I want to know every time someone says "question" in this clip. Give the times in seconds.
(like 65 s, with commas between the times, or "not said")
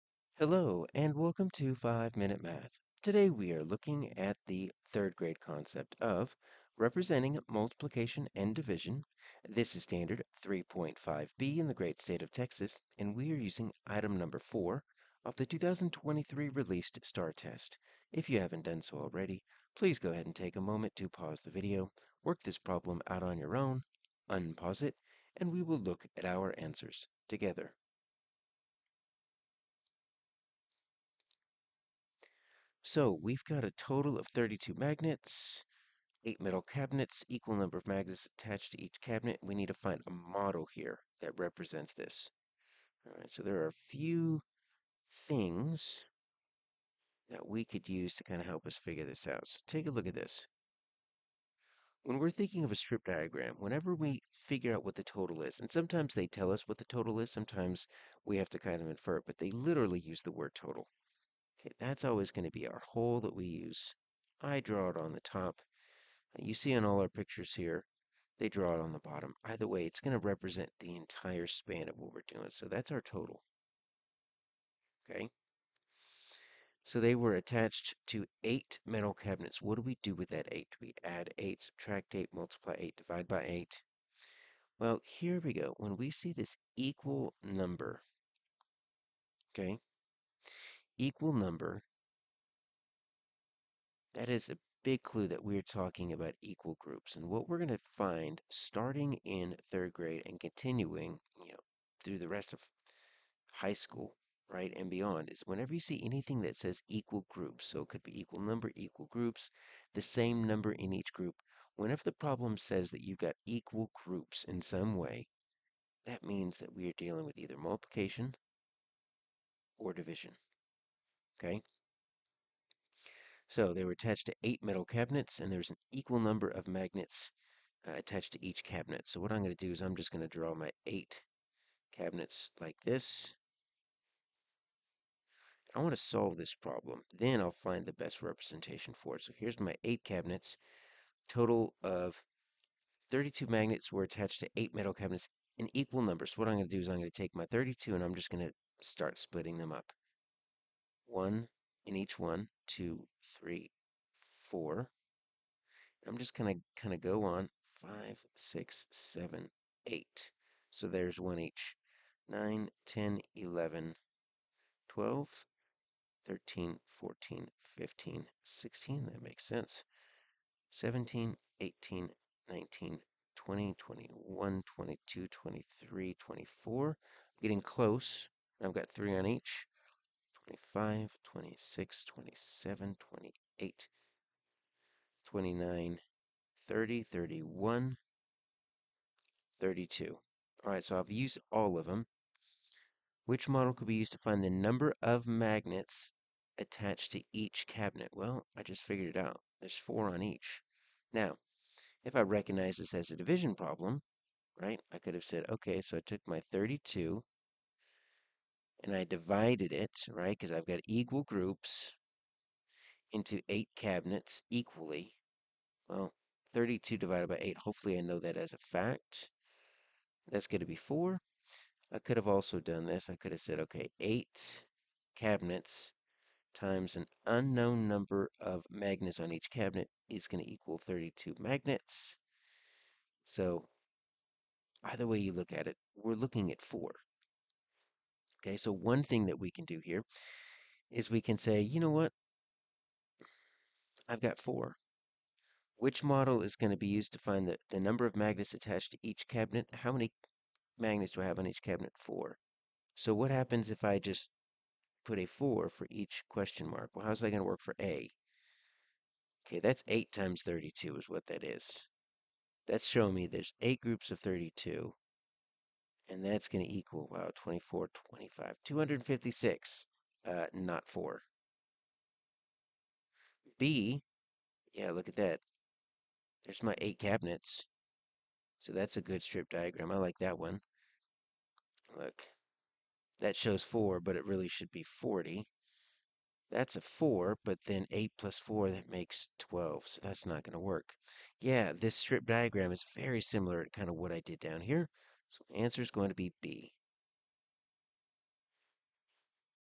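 256 s.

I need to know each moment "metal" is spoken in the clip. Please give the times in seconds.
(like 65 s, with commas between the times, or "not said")
36 s, 78 s, 124 s, 144 s.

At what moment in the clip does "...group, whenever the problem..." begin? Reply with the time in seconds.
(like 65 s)
111 s.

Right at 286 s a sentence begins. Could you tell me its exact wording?
That's a 4, but then 8 plus 4, that makes 12, so that's not going to work.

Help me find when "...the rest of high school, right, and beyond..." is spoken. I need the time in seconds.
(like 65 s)
102 s.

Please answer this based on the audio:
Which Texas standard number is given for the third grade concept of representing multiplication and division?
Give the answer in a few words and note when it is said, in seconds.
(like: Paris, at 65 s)
3.5b, at 10 s.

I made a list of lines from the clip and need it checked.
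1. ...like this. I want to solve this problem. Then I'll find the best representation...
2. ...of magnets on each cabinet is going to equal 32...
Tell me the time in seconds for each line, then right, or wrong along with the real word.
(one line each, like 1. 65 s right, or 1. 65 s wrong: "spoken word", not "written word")
1. 132 s right
2. 228 s right.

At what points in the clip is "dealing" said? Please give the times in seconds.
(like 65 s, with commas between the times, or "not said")
116 s.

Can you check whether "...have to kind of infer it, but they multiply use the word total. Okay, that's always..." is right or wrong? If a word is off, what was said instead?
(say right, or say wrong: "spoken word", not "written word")
wrong: "literally", not "multiply".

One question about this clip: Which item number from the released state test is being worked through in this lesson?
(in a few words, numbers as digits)
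4.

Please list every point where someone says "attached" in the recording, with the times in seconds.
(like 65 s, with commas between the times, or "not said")
38 s, 77 s, 123 s, 127 s, 144 s, 196 s, 248 s.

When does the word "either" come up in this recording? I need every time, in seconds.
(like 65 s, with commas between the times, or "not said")
69 s, 117 s, 234 s.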